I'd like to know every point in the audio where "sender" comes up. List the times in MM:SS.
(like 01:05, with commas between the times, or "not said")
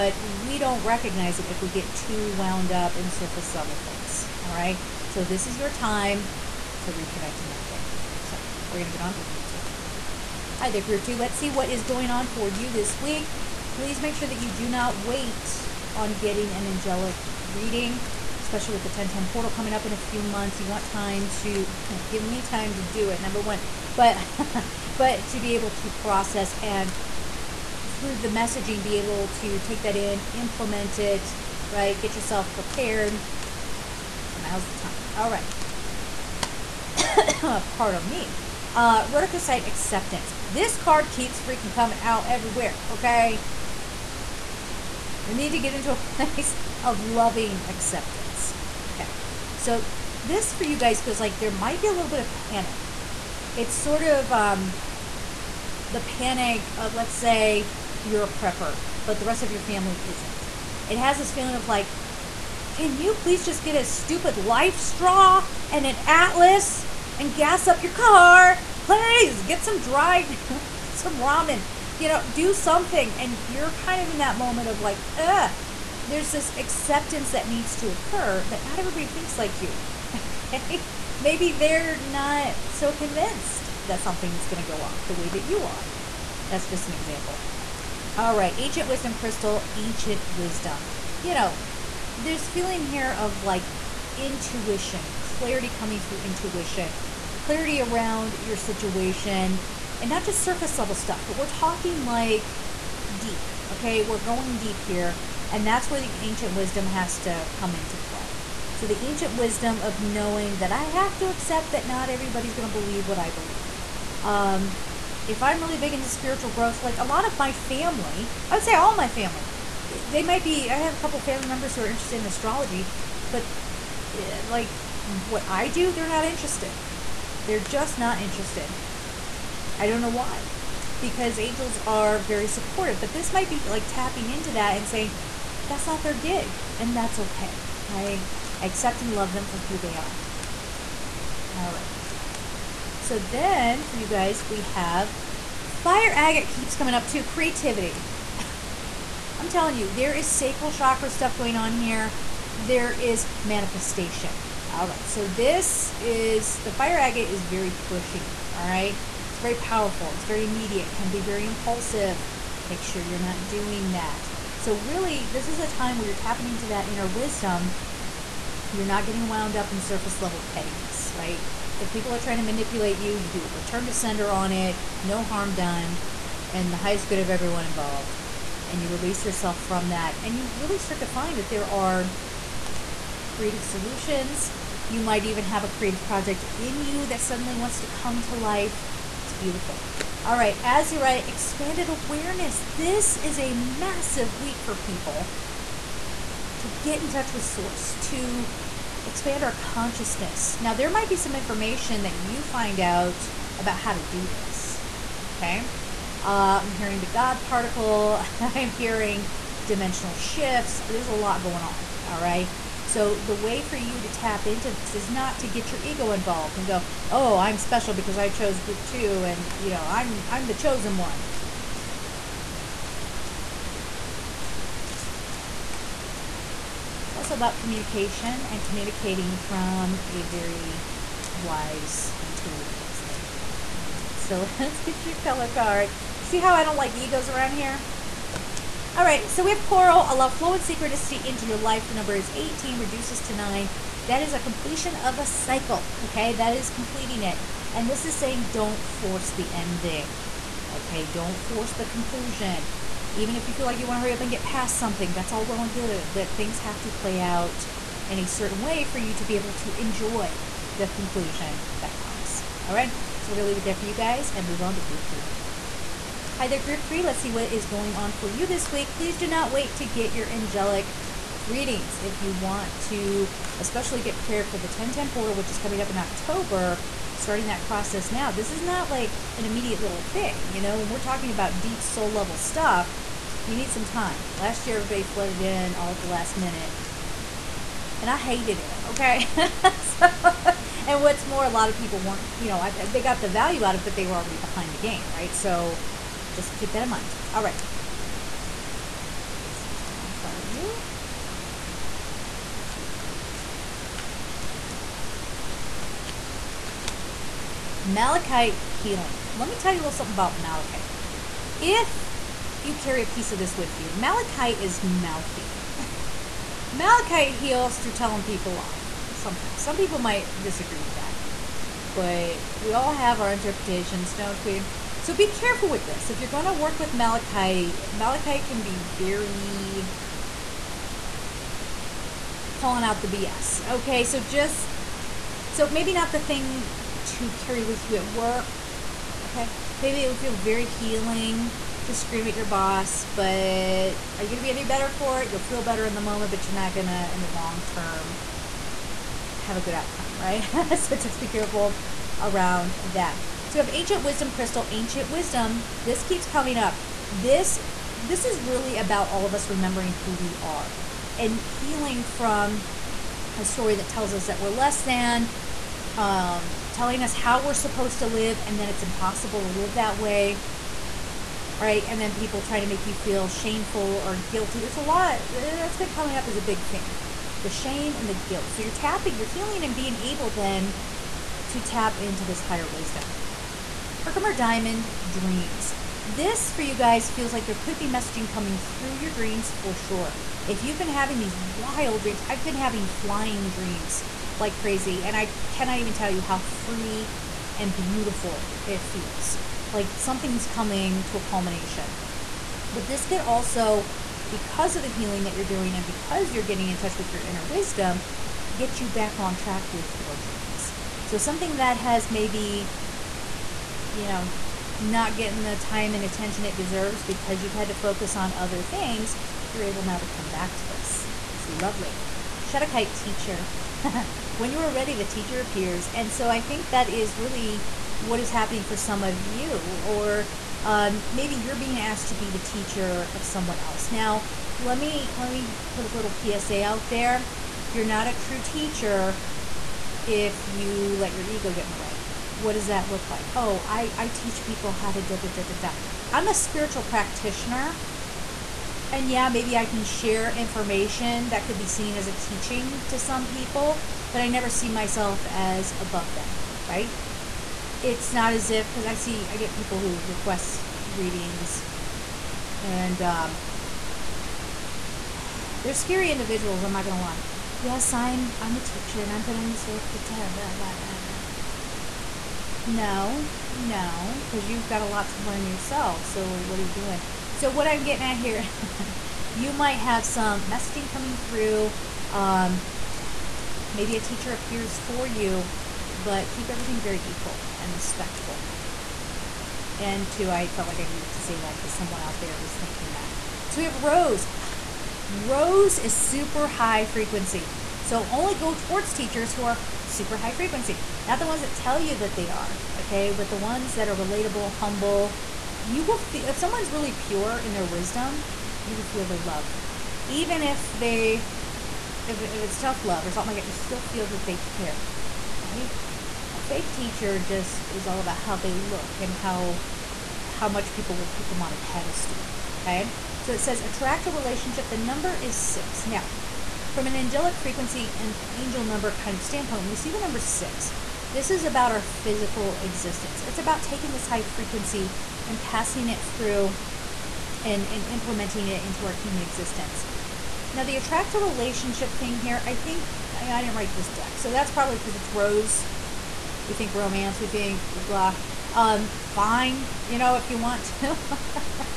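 02:53.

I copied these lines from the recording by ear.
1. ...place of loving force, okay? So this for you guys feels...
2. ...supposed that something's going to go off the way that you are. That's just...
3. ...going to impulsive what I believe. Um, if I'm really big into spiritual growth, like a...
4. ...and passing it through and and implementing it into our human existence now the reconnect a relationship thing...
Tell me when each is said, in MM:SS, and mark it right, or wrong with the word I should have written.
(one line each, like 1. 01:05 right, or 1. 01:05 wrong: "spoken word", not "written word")
1. 00:45 wrong: "acceptance", not "force"
2. 01:22 wrong: "convinced", not "supposed"
3. 01:52 wrong: "believe", not "impulsive"
4. 08:55 wrong: "attract", not "reconnect".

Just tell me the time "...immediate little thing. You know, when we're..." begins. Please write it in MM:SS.
04:39.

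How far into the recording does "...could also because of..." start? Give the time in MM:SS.
06:43.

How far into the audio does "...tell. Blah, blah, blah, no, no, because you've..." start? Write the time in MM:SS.
07:50.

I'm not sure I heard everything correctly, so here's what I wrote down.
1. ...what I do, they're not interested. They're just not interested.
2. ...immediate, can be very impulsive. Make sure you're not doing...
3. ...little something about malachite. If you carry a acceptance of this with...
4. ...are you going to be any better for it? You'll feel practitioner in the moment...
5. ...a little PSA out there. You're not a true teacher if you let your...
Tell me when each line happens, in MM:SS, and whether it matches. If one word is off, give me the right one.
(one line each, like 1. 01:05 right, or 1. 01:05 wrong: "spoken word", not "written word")
1. 02:05 right
2. 02:40 right
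3. 05:09 wrong: "piece", not "acceptance"
4. 05:44 wrong: "better", not "practitioner"
5. 07:15 right.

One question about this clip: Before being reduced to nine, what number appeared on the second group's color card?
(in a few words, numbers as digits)
18.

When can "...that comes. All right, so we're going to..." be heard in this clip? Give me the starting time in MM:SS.
04:21.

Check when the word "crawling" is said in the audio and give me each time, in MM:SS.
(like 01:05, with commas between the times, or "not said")
not said.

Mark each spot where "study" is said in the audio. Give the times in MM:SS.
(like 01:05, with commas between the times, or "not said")
not said.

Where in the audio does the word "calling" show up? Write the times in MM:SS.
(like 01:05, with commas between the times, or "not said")
05:32.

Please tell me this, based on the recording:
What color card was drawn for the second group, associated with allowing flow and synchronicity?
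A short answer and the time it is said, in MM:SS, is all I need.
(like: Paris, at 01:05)
Coral, at 03:59.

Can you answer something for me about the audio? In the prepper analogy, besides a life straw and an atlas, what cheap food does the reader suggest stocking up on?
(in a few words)
ramen.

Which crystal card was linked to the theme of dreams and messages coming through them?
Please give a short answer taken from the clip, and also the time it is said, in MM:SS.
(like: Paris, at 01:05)
Herkimer Diamond, at 06:24.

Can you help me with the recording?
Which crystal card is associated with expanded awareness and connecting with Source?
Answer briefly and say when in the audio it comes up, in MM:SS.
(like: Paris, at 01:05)
Azurite, at 03:10.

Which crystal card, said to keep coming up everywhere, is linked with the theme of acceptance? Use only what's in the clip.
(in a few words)
Rhodochrosite.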